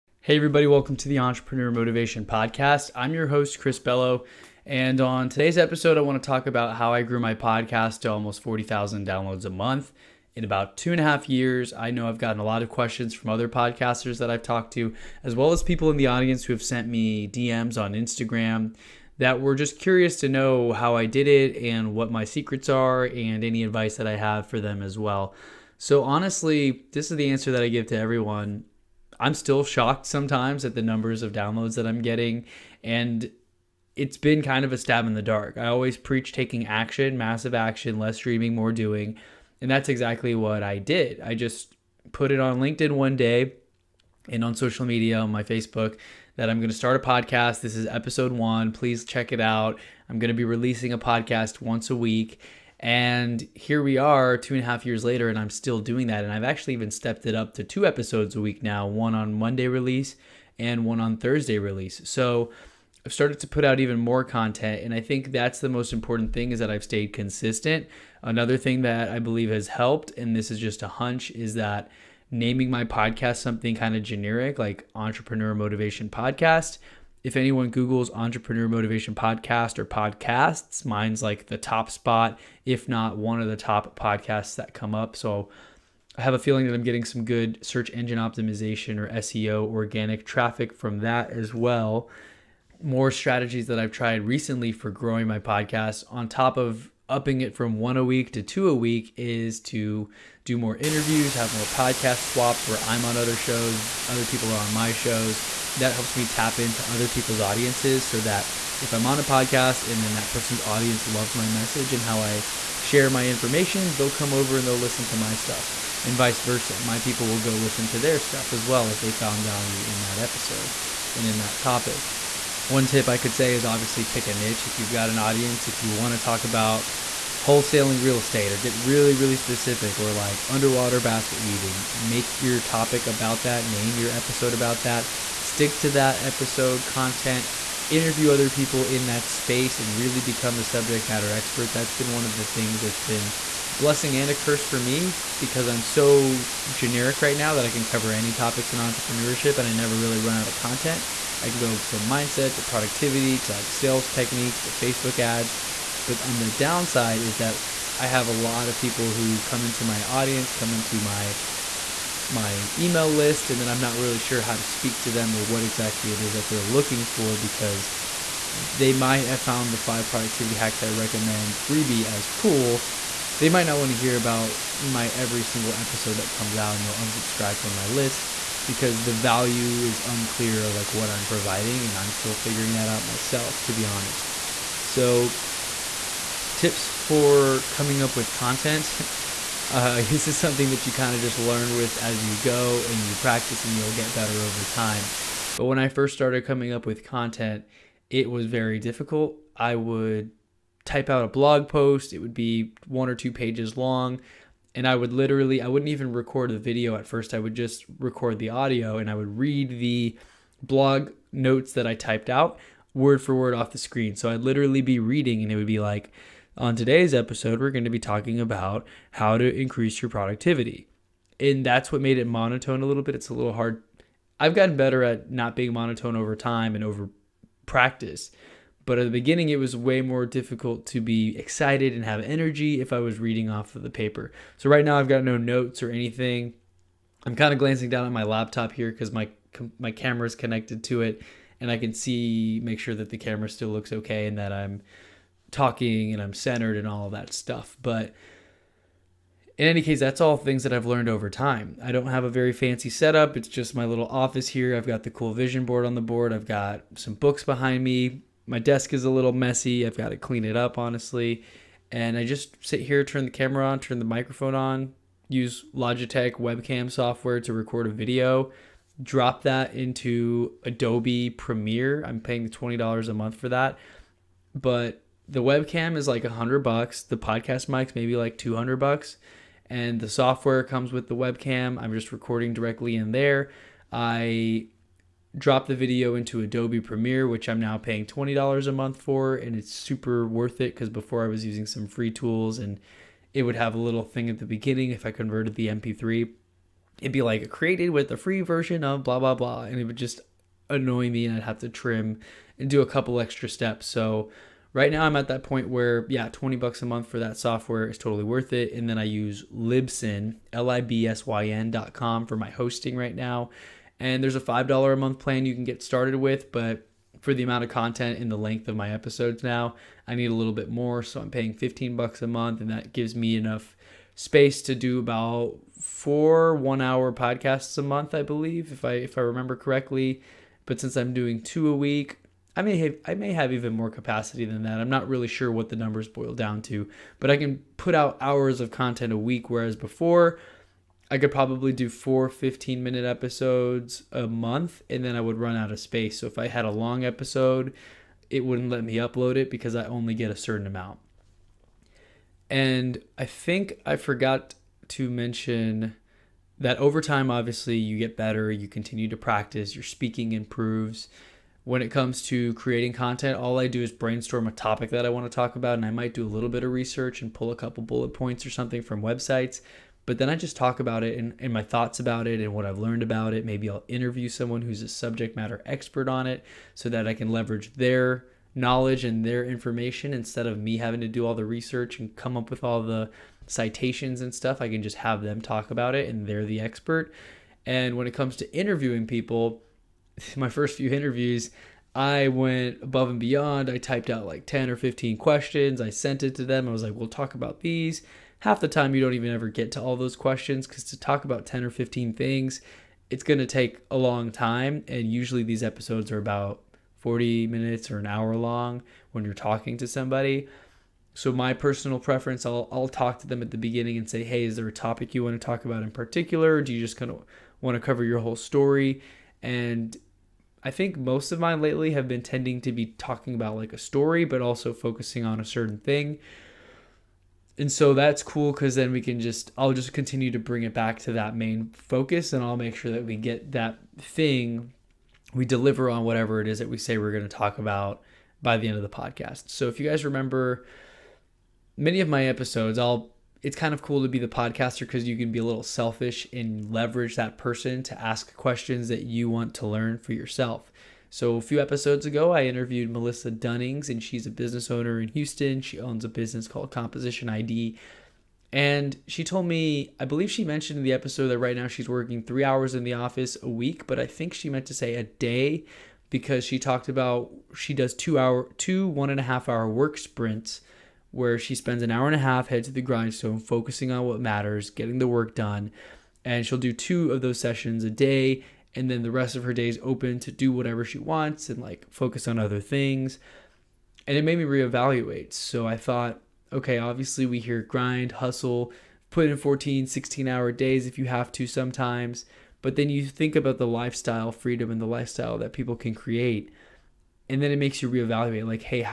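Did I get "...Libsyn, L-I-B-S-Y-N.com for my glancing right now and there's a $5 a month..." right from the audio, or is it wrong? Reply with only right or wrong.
wrong.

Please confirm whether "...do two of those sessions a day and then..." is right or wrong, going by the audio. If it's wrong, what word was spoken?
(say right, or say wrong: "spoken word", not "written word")
right.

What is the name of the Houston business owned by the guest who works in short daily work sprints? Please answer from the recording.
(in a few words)
Composition ID.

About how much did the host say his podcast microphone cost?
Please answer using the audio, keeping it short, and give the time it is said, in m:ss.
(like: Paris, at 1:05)
$200, at 4:38.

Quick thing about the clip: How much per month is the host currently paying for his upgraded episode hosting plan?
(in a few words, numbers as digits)
$15.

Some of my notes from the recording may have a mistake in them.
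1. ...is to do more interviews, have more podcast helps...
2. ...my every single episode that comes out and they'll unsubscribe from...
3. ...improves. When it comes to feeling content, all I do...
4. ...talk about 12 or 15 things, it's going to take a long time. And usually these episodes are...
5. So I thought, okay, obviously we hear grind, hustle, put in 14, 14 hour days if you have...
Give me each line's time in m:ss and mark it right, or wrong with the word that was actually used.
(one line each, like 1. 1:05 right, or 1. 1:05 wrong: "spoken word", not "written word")
1. 1:39 wrong: "swaps", not "helps"
2. 2:54 right
3. 6:00 wrong: "creating", not "feeling"
4. 6:40 wrong: "10", not "12"
5. 8:05 wrong: "16", not "14".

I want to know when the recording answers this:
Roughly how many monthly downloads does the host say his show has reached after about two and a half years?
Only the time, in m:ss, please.
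0:08.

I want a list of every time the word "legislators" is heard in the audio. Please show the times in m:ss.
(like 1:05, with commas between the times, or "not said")
not said.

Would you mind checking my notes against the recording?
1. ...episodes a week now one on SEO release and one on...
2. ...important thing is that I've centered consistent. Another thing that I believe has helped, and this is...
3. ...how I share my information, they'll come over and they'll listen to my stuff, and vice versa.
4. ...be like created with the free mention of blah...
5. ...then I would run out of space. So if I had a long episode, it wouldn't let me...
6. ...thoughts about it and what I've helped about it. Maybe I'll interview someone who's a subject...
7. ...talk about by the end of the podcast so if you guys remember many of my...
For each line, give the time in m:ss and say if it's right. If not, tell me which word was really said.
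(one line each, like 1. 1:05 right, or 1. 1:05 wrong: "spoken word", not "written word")
1. 0:57 wrong: "Monday", not "SEO"
2. 1:05 wrong: "stayed", not "centered"
3. 1:52 right
4. 4:57 wrong: "version", not "mention"
5. 5:45 right
6. 6:11 wrong: "learned", not "helped"
7. 7:17 right.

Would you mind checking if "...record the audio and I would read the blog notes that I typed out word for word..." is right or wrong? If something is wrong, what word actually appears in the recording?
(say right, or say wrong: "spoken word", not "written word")
right.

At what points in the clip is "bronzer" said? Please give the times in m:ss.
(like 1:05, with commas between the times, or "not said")
not said.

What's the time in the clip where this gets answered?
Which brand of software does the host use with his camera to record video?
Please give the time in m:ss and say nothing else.
4:25.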